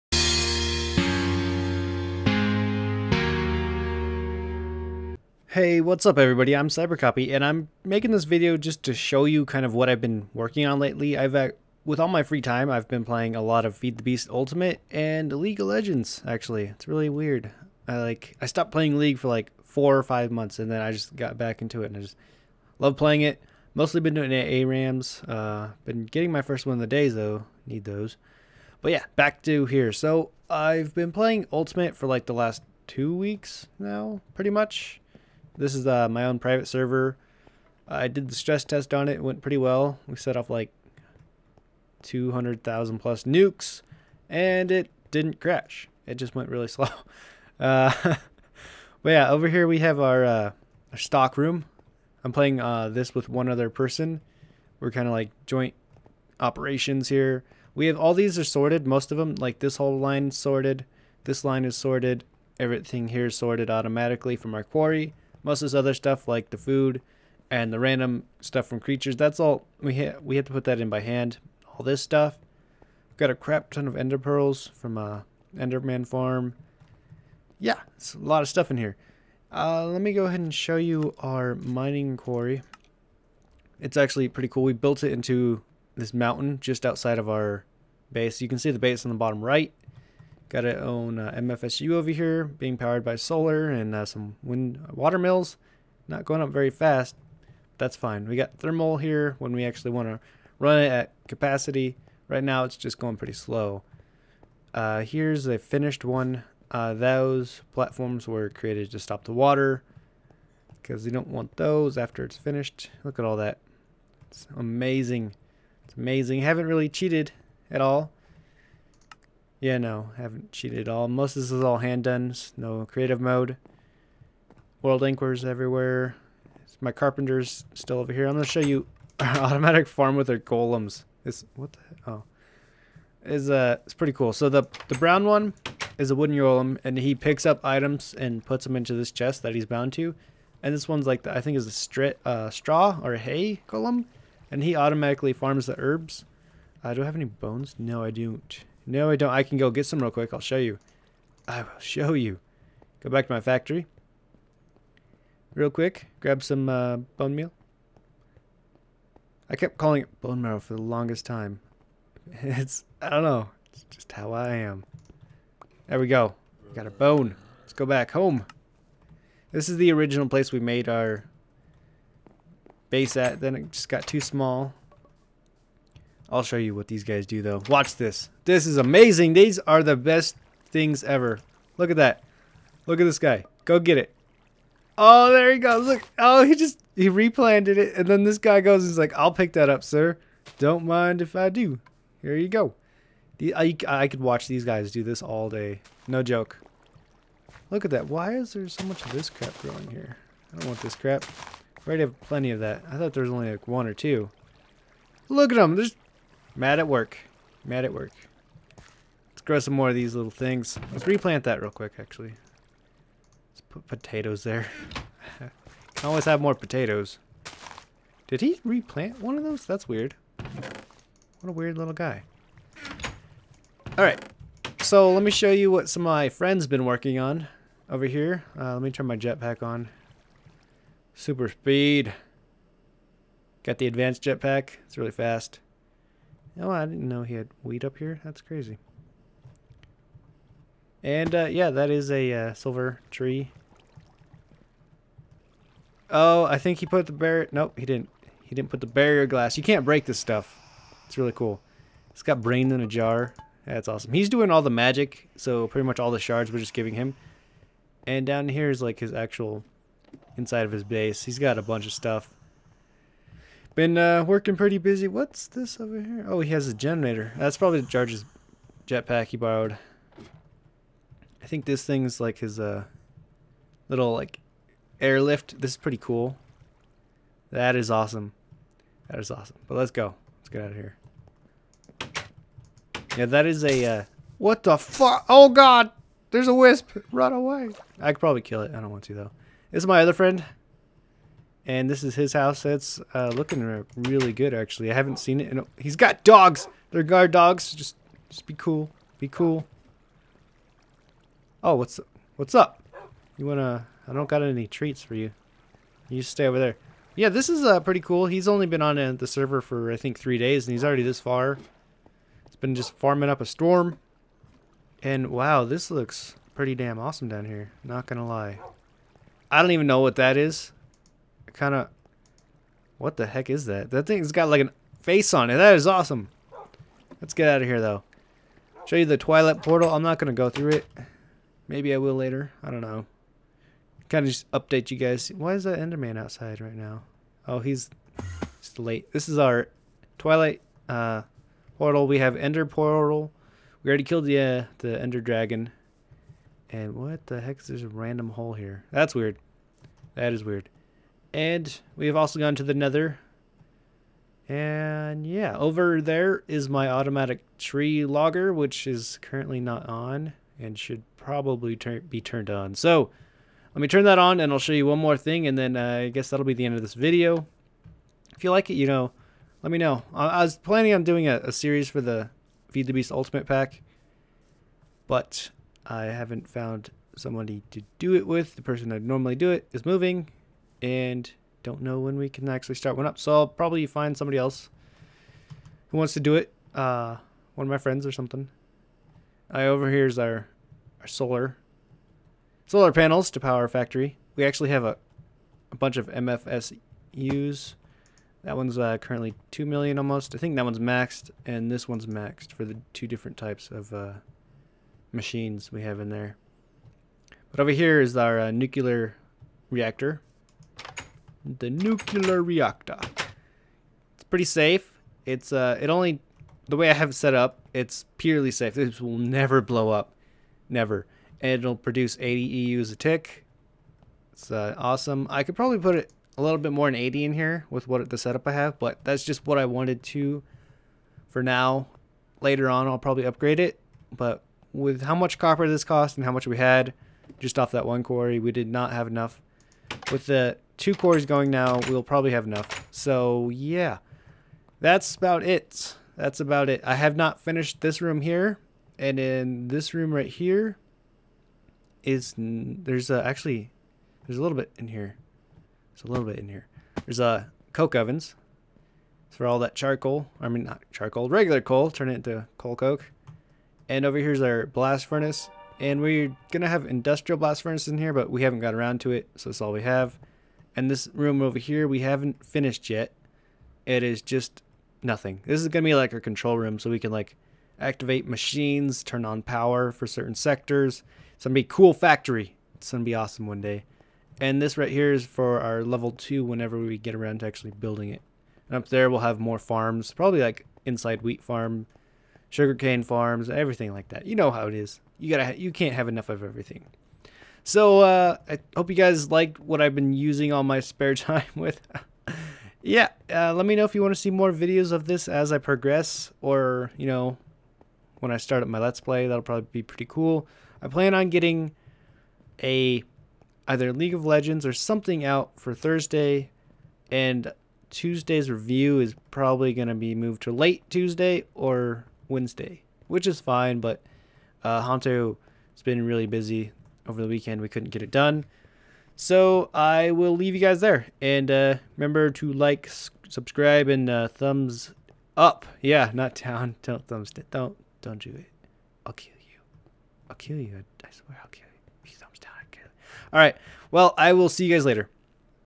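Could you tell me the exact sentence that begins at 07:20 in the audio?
With the two cores going now.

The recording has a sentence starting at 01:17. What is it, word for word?
Yeah, it's a lot of stuff in here.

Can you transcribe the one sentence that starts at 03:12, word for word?
Here you go." The, I I could watch these guys do this all day.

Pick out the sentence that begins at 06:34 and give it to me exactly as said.
We actually have a a bunch of MFSUs.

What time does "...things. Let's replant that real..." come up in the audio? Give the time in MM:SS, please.
03:30.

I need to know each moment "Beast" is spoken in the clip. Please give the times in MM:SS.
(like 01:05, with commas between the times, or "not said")
00:14, 06:12.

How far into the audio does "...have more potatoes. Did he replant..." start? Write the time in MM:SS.
03:36.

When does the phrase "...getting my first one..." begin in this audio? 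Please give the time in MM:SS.
00:26.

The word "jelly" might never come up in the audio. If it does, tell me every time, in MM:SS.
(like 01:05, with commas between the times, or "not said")
not said.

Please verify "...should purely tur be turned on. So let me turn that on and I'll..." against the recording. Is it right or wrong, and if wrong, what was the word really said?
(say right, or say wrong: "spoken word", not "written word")
wrong: "probably", not "purely".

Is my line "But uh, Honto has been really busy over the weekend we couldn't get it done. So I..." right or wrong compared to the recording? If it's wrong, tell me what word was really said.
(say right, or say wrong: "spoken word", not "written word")
right.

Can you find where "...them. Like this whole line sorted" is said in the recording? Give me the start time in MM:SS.
00:59.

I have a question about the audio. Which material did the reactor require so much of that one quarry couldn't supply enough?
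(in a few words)
Copper.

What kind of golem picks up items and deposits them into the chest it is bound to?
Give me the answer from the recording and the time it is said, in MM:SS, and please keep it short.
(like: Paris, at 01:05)
Wooden golem, at 02:16.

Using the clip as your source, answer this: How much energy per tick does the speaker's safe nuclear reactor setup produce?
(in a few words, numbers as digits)
80 EU.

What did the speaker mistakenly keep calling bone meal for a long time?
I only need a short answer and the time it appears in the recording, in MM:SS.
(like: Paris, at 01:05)
Bone marrow, at 02:40.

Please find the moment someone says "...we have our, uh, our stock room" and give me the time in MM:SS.
00:49.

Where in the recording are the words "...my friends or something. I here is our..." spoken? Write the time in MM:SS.
06:27.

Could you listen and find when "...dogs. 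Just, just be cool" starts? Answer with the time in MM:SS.
04:57.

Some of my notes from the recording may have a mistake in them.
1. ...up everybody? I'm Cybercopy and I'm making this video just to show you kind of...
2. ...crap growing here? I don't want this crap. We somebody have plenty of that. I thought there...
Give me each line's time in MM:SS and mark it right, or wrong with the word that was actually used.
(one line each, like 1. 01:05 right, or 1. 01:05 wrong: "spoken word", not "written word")
1. 00:06 right
2. 03:19 wrong: "already", not "somebody".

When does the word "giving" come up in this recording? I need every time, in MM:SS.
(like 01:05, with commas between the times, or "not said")
04:16.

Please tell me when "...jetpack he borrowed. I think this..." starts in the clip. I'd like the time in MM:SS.
04:28.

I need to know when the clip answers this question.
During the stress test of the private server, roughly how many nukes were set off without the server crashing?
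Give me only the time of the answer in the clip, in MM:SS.
00:42.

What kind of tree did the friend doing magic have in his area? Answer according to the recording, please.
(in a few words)
Silver tree.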